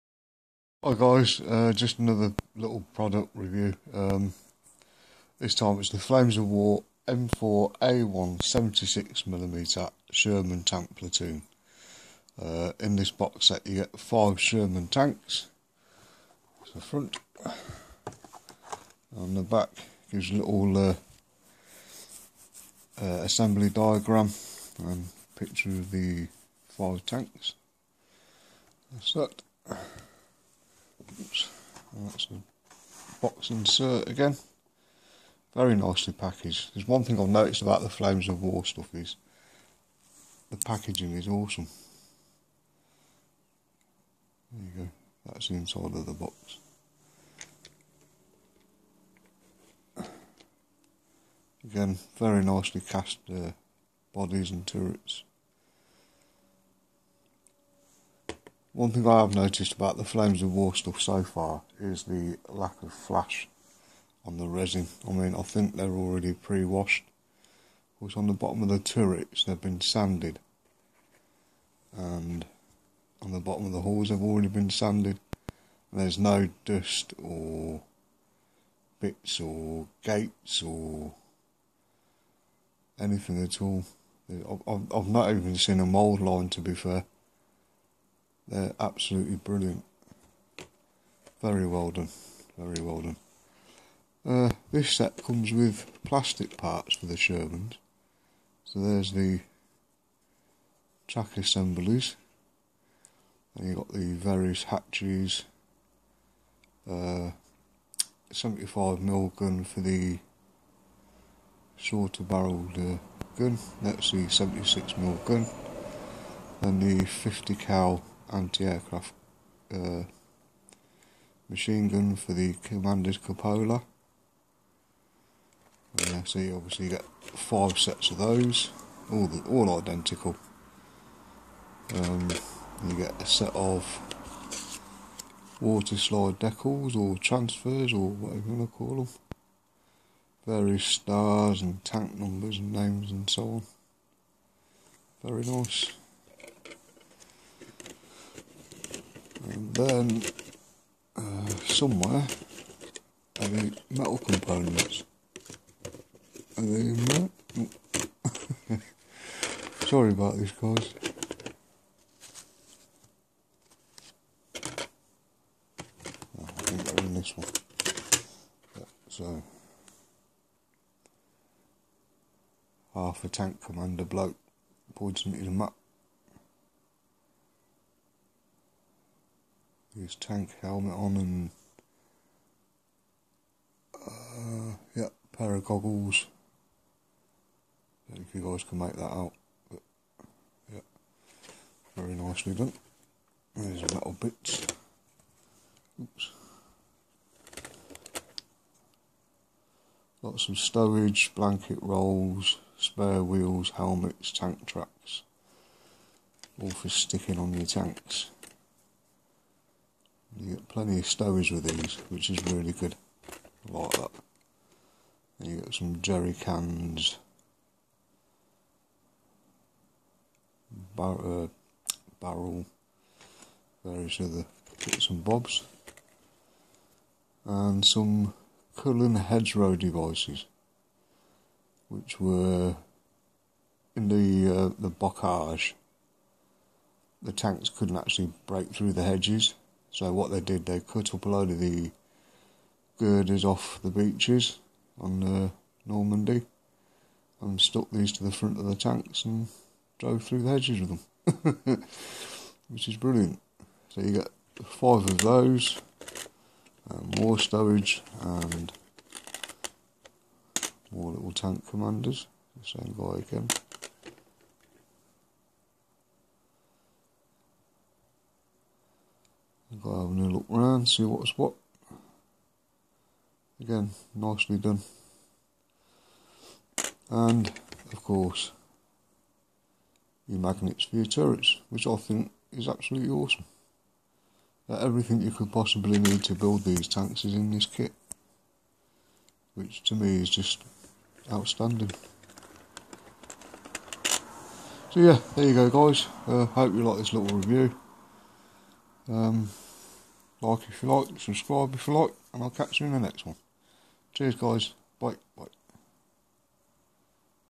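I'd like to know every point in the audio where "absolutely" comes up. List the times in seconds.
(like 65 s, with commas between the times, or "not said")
88 s, 282 s.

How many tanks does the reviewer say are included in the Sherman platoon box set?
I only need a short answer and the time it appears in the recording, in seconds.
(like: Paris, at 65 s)
5, at 13 s.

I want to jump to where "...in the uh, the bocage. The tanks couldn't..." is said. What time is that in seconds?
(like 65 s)
233 s.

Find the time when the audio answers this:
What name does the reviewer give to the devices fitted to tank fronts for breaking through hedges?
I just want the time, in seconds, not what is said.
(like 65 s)
228 s.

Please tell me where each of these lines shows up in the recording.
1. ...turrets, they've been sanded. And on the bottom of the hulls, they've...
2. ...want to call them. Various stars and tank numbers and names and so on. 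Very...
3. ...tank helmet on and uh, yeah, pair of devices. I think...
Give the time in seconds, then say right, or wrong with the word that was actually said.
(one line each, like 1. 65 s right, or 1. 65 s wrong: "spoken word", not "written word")
1. 68 s right
2. 138 s right
3. 180 s wrong: "goggles", not "devices".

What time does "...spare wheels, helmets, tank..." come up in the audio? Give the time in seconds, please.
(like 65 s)
202 s.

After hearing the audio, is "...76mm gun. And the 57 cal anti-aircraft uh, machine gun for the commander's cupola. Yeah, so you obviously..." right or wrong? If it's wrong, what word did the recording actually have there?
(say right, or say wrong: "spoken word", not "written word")
wrong: "50", not "57".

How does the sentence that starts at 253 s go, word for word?
So you get five of those, more um, stowage and more little tank commanders, the same guy again.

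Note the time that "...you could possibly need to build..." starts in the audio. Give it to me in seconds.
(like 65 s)
285 s.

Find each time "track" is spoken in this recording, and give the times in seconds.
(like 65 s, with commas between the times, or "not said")
101 s, 204 s.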